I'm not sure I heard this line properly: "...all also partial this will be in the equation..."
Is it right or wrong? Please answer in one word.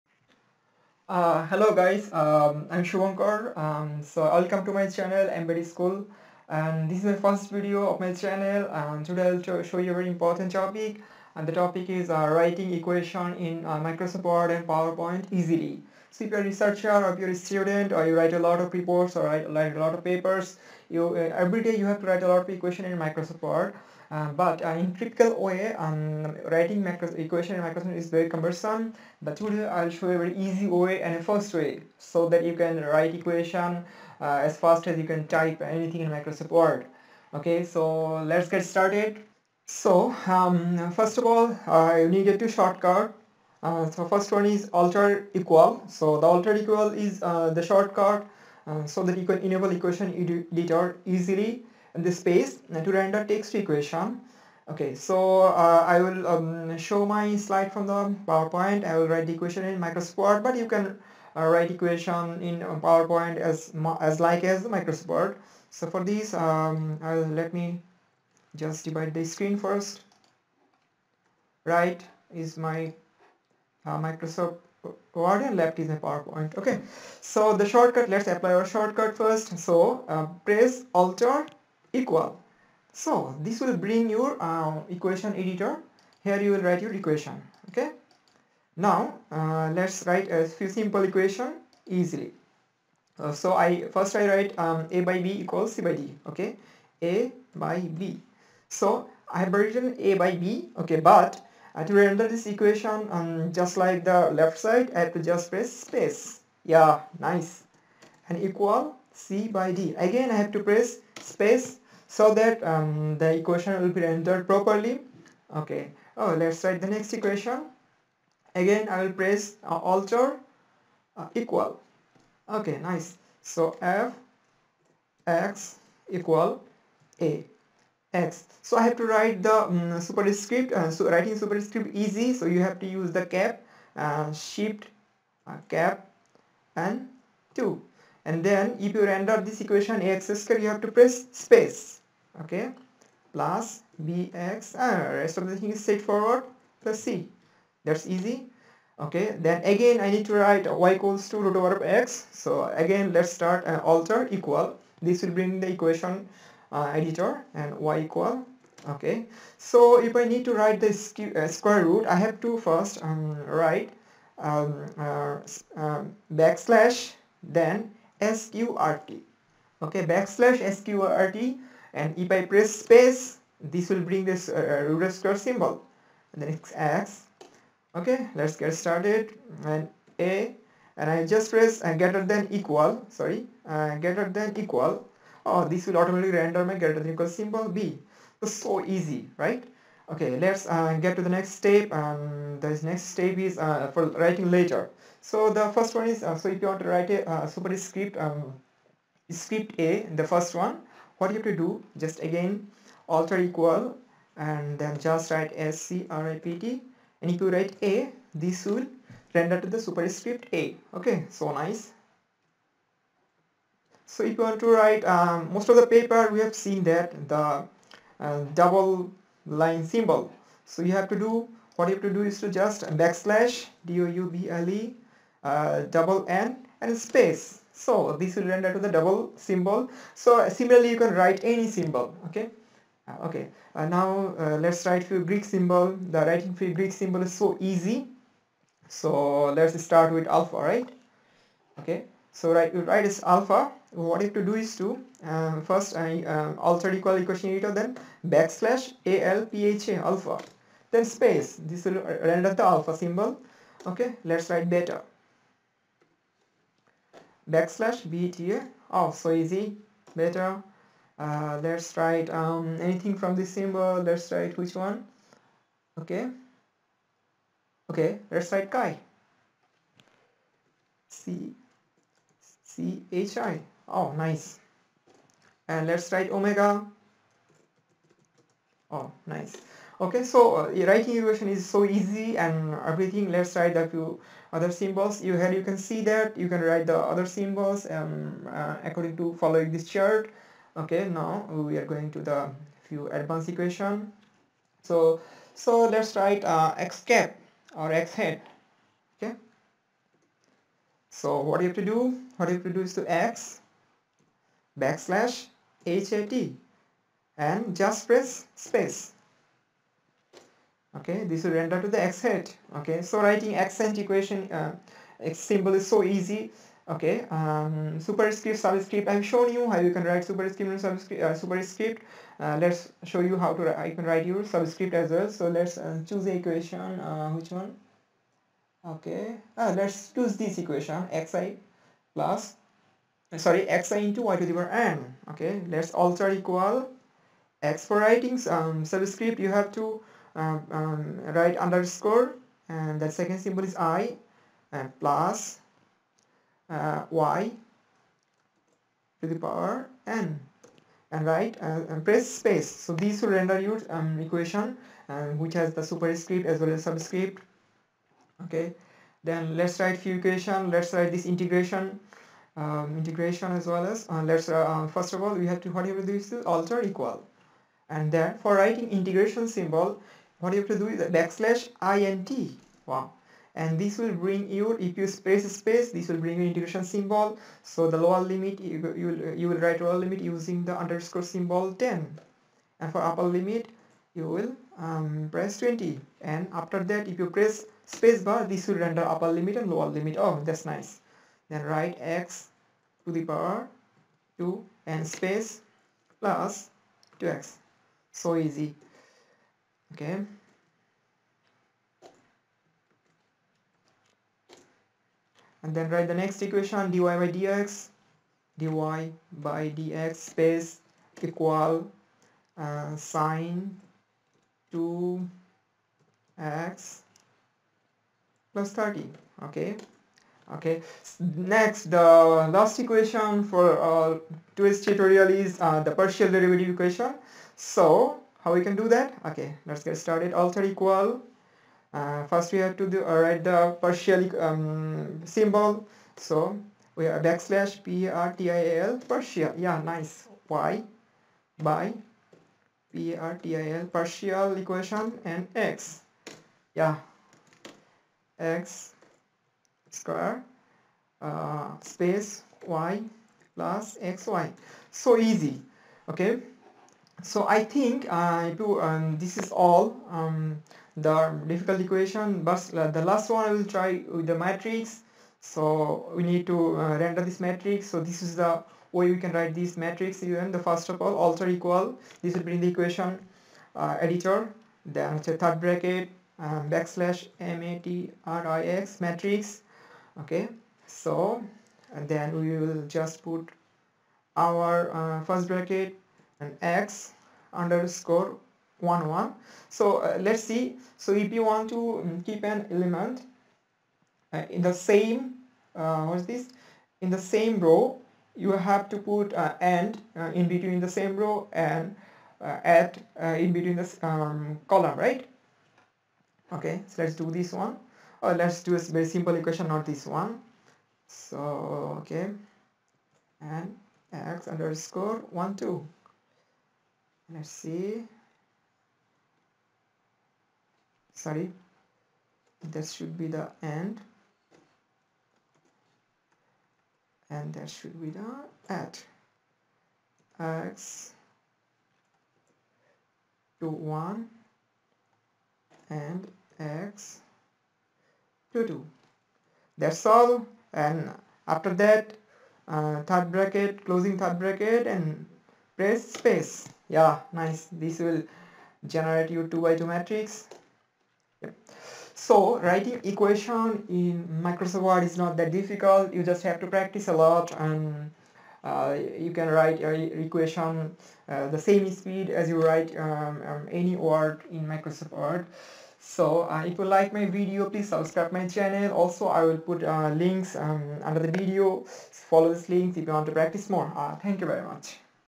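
wrong.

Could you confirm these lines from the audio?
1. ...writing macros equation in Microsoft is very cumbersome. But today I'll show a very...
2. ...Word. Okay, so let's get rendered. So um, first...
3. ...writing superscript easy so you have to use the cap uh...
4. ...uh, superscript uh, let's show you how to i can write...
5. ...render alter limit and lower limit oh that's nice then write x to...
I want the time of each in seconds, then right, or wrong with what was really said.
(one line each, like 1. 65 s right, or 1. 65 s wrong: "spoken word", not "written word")
1. 26 s right
2. 36 s wrong: "started", not "rendered"
3. 131 s right
4. 321 s right
5. 388 s wrong: "upper", not "alter".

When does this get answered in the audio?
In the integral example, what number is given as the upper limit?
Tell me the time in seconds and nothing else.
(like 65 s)
385 s.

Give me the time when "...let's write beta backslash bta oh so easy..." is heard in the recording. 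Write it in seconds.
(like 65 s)
254 s.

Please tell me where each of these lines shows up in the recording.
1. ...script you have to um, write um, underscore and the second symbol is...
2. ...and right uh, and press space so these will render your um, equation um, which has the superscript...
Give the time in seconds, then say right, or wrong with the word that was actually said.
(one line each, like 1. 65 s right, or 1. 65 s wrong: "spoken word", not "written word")
1. 338 s wrong: "subscript", not "script"
2. 351 s right.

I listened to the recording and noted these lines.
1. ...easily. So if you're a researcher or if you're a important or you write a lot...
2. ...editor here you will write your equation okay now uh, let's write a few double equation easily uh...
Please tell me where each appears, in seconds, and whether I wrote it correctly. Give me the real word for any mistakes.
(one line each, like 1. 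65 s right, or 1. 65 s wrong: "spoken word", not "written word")
1. 15 s wrong: "student", not "important"
2. 85 s wrong: "simple", not "double".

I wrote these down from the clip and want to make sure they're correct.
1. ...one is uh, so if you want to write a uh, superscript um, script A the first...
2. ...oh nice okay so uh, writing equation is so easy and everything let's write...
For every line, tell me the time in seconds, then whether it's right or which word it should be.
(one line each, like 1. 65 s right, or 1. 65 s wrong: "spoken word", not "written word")
1. 195 s right
2. 278 s right.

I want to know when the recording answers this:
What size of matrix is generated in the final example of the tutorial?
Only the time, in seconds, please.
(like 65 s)
549 s.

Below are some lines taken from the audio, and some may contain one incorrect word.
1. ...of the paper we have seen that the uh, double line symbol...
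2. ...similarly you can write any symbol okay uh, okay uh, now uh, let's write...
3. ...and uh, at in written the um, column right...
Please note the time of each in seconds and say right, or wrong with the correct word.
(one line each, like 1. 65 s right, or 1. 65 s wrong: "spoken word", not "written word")
1. 215 s right
2. 230 s right
3. 501 s wrong: "between", not "written".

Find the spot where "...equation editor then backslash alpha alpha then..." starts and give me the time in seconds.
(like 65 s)
247 s.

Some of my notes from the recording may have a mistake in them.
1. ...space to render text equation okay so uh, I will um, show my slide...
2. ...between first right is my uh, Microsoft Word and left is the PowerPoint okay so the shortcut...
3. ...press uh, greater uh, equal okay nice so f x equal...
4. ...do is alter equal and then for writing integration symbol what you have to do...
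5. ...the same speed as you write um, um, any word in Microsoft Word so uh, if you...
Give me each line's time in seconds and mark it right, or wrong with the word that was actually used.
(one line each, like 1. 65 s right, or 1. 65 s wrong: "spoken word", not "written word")
1. 52 s right
2. 69 s wrong: "screen", not "between"
3. 119 s wrong: "alter", not "greater"
4. 366 s right
5. 561 s right.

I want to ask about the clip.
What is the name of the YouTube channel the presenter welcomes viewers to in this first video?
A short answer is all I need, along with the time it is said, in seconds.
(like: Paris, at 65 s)
Embed School, at 5 s.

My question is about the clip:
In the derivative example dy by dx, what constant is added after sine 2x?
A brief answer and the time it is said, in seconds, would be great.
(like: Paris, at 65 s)
30, at 418 s.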